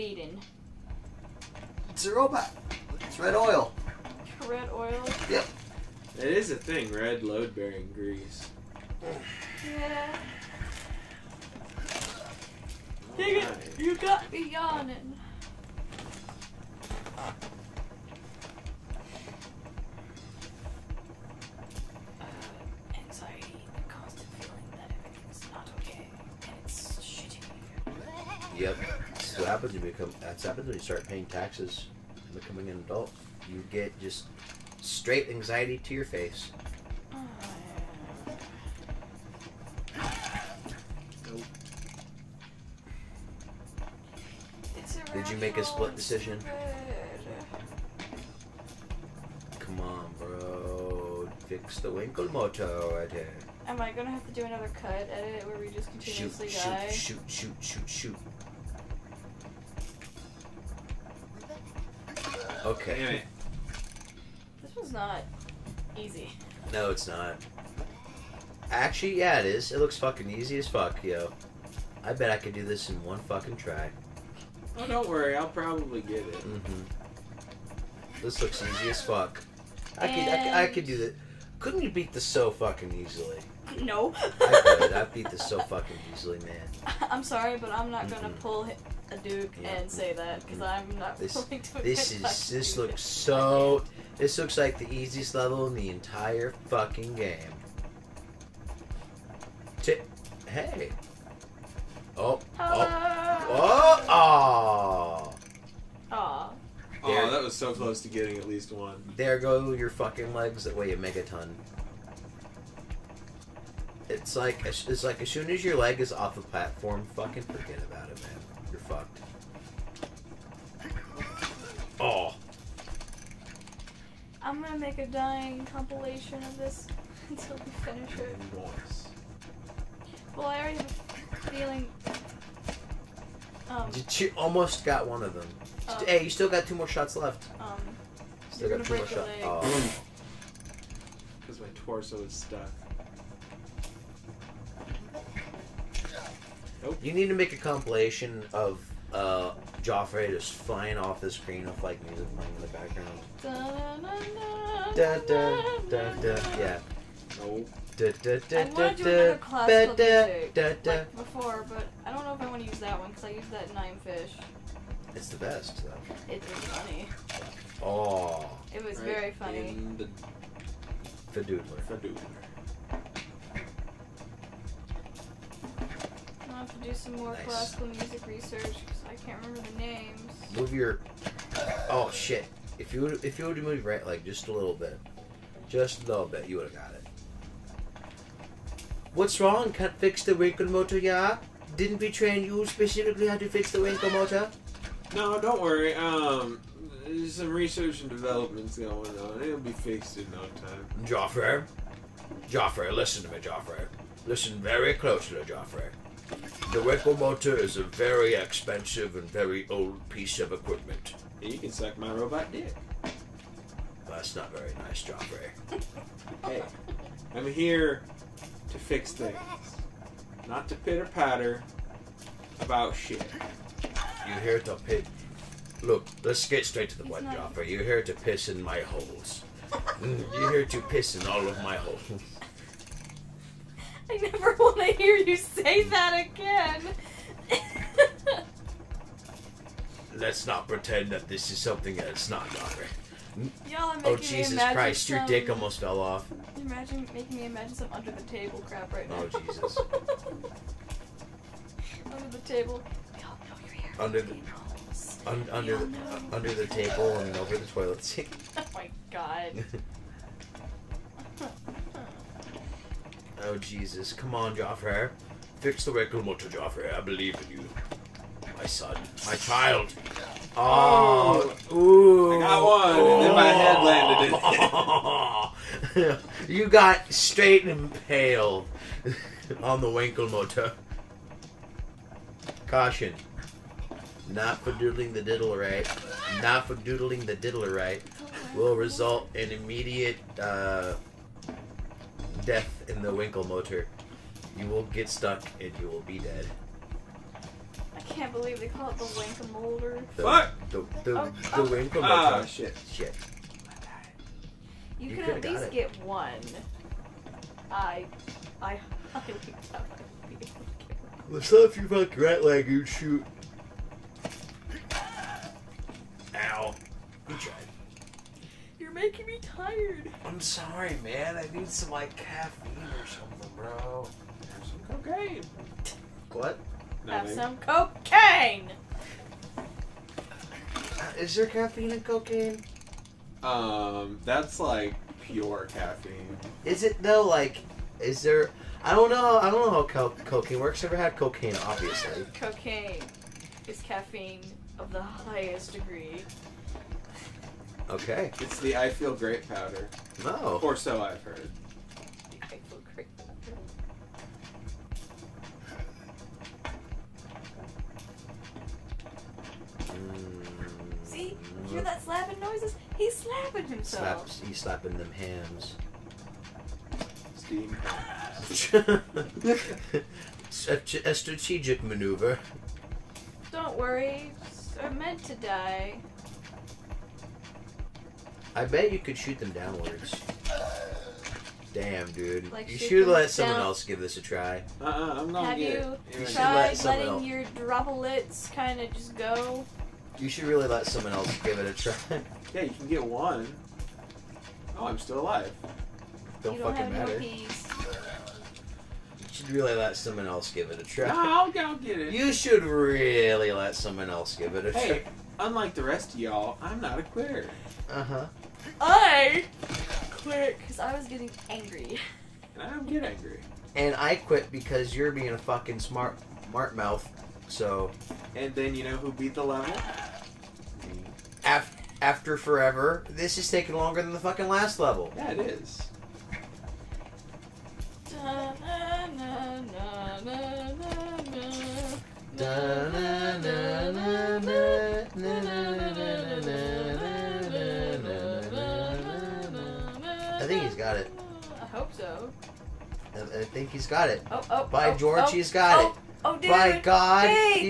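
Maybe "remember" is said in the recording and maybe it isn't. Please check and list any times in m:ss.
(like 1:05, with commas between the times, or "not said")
2:59.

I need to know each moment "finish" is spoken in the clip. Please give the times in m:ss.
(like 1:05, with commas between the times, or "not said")
2:07.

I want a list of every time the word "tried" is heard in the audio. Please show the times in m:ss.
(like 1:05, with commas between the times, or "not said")
6:26.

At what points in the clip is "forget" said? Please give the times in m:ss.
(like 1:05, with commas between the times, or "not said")
1:57.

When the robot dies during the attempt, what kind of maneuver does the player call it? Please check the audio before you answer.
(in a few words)
Strategic.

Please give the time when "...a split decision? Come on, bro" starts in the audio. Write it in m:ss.
0:45.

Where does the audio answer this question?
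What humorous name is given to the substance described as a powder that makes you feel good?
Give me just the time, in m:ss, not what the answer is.
5:48.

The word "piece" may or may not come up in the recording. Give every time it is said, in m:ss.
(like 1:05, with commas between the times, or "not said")
3:30.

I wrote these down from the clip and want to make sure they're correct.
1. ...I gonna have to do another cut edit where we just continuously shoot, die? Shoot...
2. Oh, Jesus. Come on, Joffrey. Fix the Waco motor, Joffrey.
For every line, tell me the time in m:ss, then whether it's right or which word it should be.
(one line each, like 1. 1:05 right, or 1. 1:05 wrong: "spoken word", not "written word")
1. 0:53 right
2. 4:23 right.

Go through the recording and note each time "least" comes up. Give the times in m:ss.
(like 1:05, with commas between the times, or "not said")
1:48, 5:05.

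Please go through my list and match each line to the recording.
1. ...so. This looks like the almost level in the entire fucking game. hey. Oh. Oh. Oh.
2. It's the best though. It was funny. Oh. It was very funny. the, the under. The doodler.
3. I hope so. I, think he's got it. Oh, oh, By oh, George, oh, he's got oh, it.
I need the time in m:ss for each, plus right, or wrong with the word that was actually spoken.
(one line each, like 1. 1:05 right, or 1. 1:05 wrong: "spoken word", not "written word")
1. 1:33 wrong: "easiest", not "almost"
2. 2:45 wrong: "doodler", not "under"
3. 7:21 right.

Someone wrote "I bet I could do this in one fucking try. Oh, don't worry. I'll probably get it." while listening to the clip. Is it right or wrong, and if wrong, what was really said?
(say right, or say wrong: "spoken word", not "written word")
right.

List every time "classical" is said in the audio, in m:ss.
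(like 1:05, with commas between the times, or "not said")
2:57.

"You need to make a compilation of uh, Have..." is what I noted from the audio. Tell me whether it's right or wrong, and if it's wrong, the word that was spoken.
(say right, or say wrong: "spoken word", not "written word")
wrong: "Joffrey", not "Have".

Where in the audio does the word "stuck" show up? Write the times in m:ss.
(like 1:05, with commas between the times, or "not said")
2:22, 4:55.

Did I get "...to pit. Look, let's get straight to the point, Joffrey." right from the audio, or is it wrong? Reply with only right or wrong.
right.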